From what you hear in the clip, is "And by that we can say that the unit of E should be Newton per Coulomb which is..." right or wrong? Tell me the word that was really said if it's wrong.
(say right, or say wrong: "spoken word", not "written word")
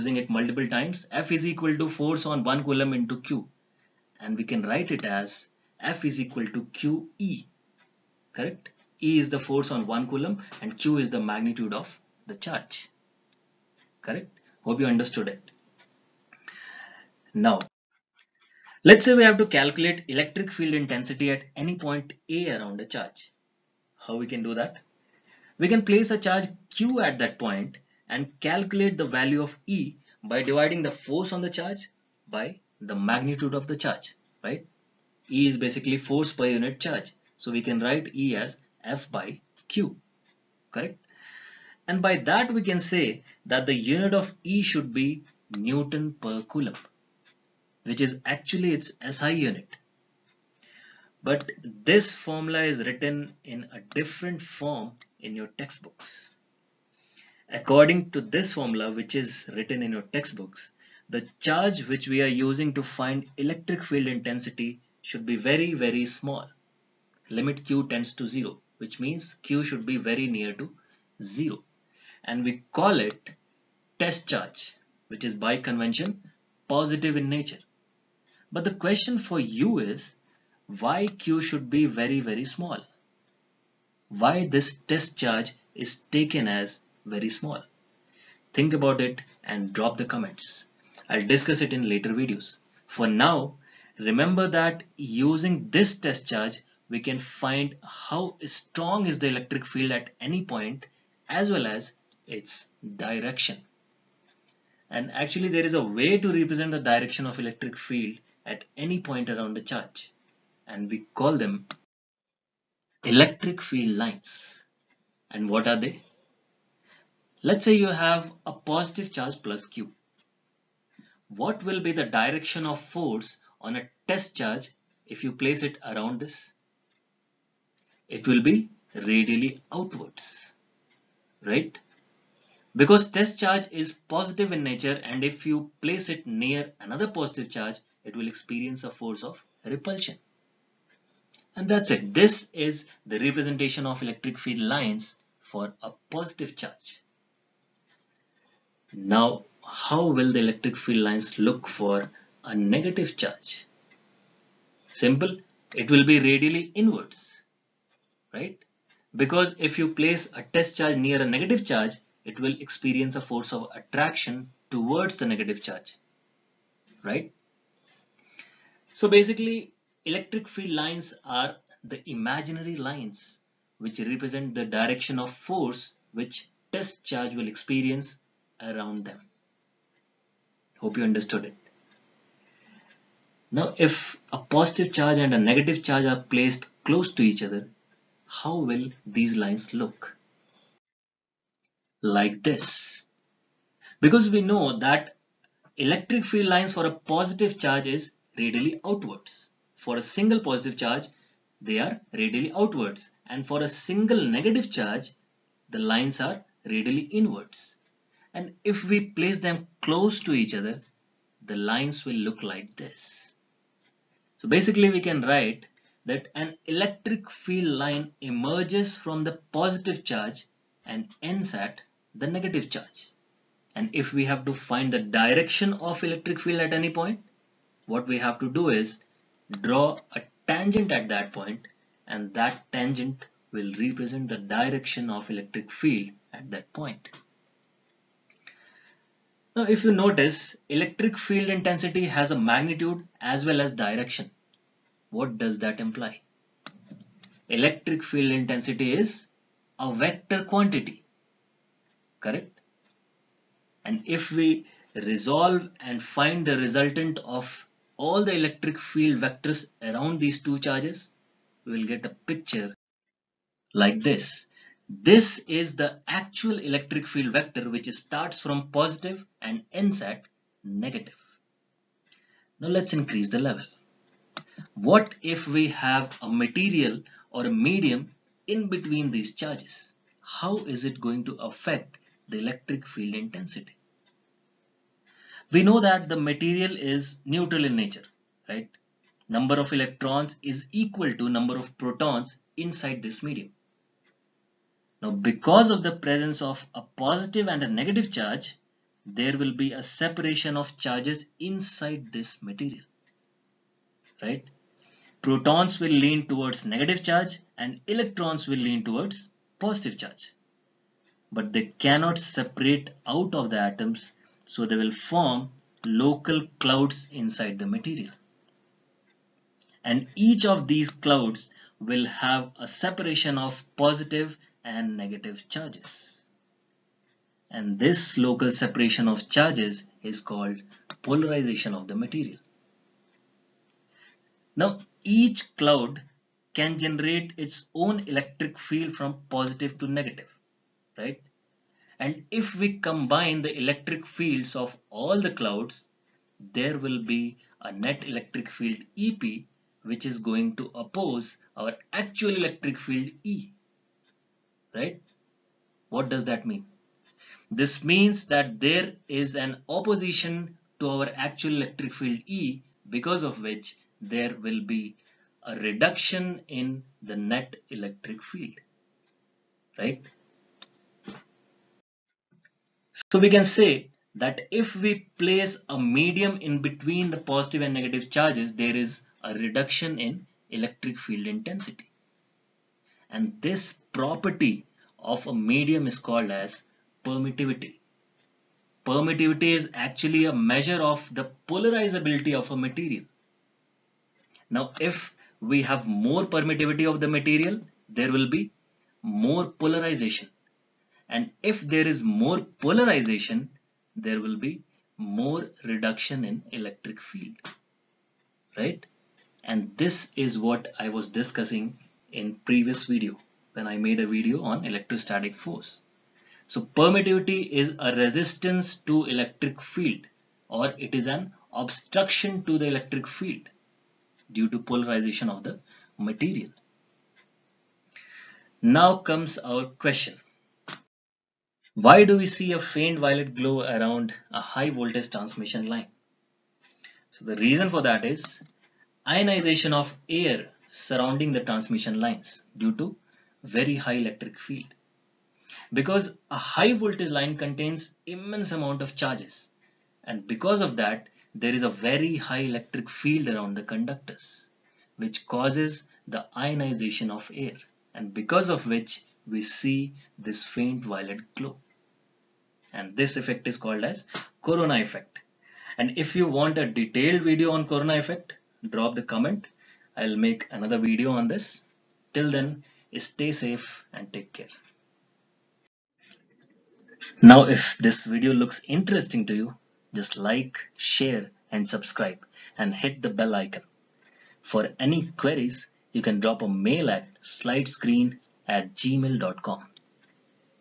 right.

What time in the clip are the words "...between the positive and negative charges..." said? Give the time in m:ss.
6:16.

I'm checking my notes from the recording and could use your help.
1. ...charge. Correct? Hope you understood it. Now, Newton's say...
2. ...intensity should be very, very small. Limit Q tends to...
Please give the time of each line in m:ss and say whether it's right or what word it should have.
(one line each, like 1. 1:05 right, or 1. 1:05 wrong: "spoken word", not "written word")
1. 0:12 wrong: "Let", not "Newton"
2. 1:04 right.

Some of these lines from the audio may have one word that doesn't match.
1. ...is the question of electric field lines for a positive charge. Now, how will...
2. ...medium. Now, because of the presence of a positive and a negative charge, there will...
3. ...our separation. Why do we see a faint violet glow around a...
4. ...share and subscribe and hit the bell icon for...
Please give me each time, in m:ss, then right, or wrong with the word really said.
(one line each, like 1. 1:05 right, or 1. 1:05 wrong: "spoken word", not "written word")
1. 2:22 wrong: "representation", not "question"
2. 4:53 right
3. 7:09 wrong: "question", not "separation"
4. 8:00 right.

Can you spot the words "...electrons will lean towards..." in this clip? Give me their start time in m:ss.
5:07.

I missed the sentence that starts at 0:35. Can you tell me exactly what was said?
E is basically force per unit charge.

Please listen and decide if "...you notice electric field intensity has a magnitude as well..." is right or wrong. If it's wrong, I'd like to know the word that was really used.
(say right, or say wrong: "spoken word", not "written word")
right.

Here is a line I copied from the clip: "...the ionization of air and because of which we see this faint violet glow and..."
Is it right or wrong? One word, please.
right.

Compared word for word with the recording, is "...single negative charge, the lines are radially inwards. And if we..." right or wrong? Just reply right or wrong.
right.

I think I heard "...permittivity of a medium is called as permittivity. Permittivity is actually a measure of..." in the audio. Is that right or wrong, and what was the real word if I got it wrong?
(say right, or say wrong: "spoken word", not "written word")
wrong: "property", not "permittivity".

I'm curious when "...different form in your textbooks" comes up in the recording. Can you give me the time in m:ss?
0:53.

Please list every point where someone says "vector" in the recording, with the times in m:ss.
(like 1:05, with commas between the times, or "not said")
4:09, 4:19, 4:27.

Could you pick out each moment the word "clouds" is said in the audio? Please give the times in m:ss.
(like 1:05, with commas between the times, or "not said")
5:16, 5:20, 5:35, 5:45.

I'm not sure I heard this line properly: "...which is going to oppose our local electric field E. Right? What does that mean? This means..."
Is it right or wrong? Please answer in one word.
wrong.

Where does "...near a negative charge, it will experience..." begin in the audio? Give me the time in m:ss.
2:40.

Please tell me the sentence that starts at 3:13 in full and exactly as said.
Because we know that electric field lines for a positive charge is radially outwards.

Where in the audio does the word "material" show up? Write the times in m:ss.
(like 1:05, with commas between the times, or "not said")
4:36, 4:46, 5:02, 5:17, 5:31, 6:32, 6:37, 7:05.